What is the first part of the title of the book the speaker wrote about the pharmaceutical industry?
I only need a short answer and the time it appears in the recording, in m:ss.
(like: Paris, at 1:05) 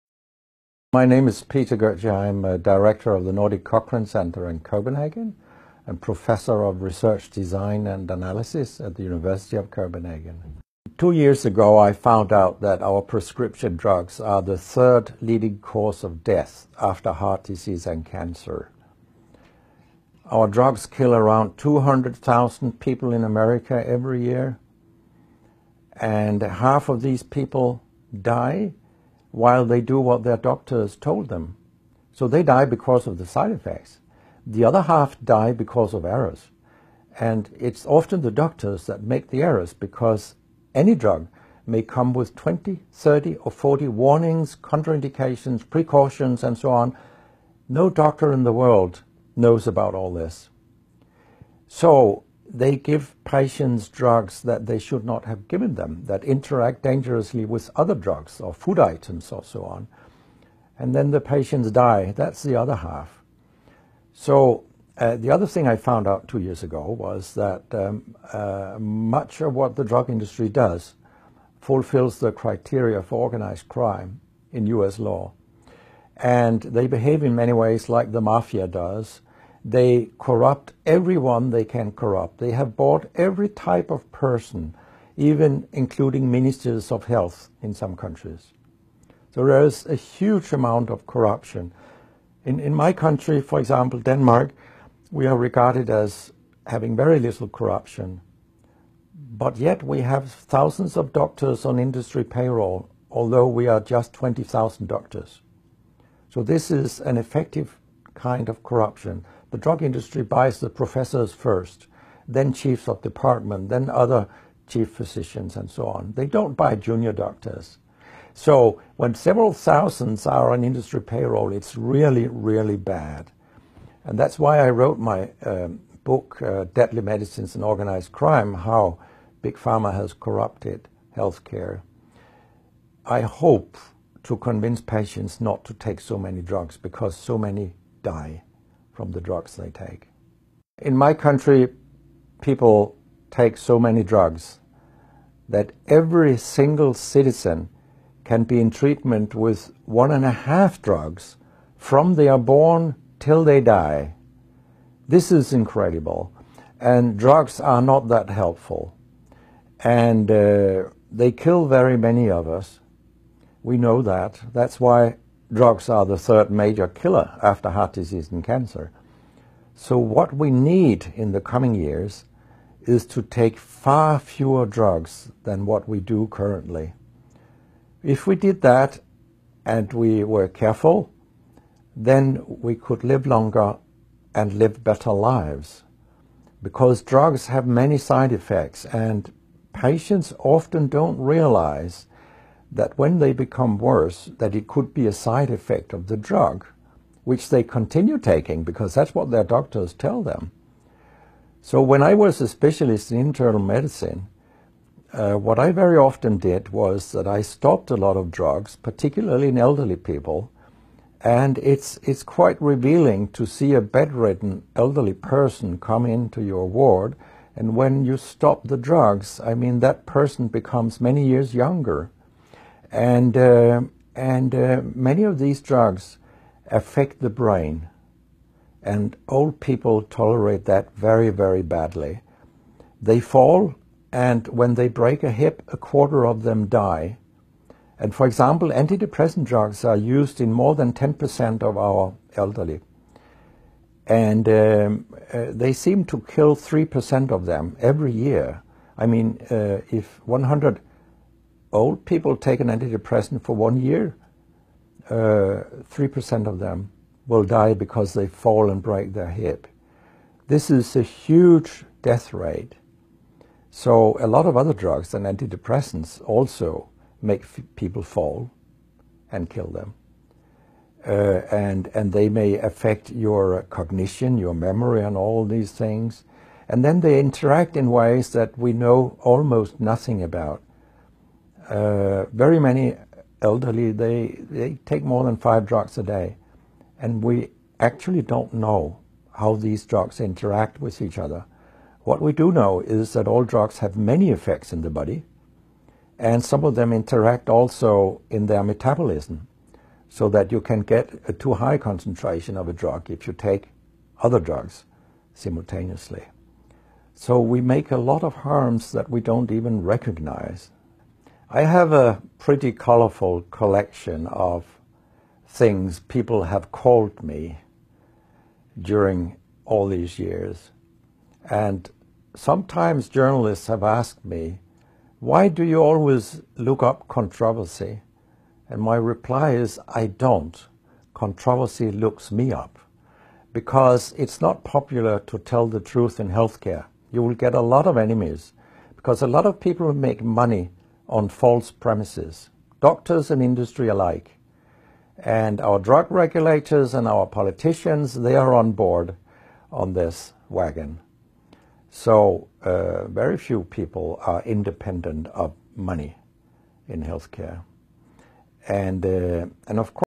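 Deadly Medicines and Organized Crime, at 2:06.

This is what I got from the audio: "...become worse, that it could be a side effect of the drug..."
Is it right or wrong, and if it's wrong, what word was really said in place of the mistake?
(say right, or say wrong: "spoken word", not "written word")
right.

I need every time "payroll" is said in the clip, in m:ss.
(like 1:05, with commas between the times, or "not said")
1:42, 2:01.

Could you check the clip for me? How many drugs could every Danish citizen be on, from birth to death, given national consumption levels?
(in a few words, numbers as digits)
1.5.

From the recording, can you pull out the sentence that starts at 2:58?
If we did that and we were careful, then we could live longer and live better lives.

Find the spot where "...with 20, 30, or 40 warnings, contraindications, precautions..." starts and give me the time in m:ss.
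0:42.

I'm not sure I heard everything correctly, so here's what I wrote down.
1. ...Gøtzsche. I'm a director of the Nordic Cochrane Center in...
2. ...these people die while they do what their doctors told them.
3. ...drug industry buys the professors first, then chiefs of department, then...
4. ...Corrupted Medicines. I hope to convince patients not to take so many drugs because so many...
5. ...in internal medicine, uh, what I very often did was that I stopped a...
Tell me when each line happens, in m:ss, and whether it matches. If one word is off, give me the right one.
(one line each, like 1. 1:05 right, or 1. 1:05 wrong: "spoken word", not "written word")
1. 0:01 right
2. 0:27 right
3. 1:49 right
4. 2:10 wrong: "Healthcare", not "Medicines"
5. 3:23 right.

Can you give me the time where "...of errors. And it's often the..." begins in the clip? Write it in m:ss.
0:35.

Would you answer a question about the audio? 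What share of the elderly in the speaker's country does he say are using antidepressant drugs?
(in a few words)
more than 10%.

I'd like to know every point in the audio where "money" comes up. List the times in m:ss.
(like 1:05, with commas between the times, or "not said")
5:40, 5:55.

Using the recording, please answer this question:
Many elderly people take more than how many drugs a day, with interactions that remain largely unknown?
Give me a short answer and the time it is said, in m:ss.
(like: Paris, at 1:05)
5, at 4:45.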